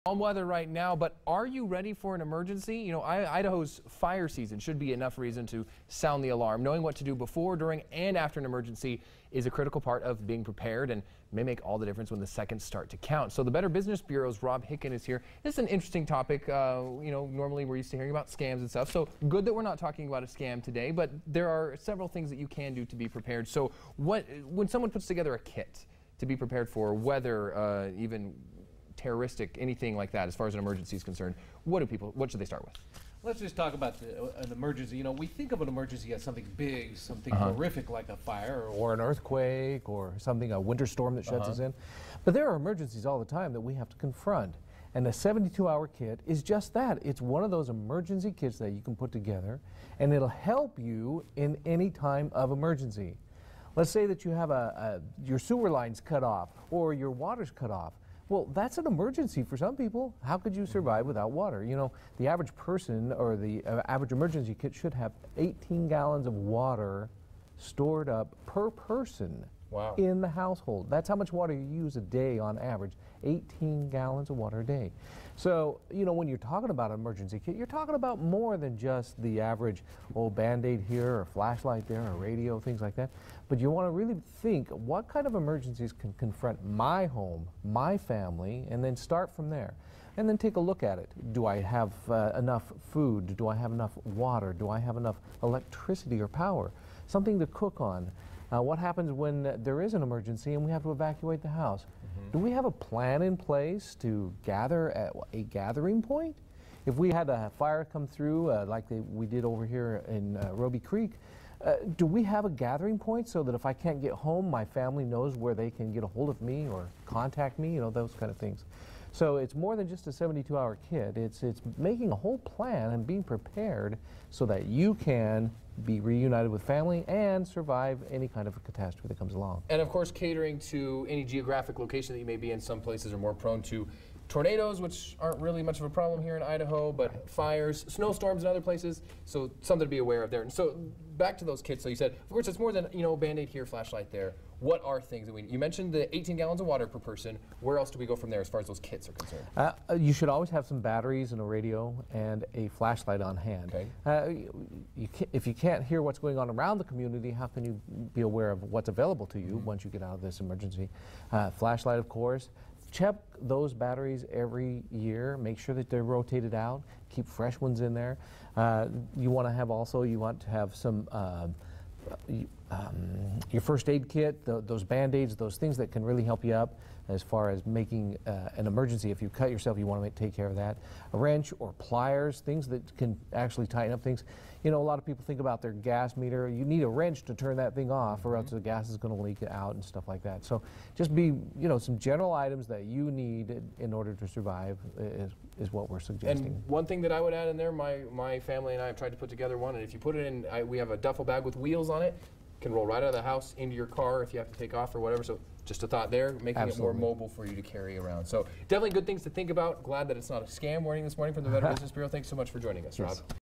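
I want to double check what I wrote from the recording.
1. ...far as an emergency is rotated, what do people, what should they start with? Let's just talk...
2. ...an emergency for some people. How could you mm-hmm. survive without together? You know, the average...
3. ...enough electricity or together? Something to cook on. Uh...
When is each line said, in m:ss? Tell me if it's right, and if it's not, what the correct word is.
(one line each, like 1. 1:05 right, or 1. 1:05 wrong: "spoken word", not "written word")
1. 0:30 wrong: "concerned", not "rotated"
2. 0:58 wrong: "water", not "together"
3. 1:34 wrong: "power", not "together".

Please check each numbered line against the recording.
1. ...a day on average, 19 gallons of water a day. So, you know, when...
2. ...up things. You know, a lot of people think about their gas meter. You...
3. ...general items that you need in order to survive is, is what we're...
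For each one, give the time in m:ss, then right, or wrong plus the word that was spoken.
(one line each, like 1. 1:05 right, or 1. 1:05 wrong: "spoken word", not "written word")
1. 1:11 wrong: "18", not "19"
2. 3:03 right
3. 3:11 right.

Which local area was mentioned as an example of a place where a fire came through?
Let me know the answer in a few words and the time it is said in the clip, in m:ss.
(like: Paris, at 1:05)
Robie Creek, at 1:50.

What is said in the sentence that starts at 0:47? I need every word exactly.
It's one of those emergency kits that you can put together, and it'll help you in any time of emergency.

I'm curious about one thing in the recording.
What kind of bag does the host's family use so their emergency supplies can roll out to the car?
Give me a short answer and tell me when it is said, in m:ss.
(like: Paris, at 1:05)
A duffel bag with wheels, at 3:20.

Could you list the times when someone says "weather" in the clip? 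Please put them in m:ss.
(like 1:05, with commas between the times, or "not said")
0:00, 0:26.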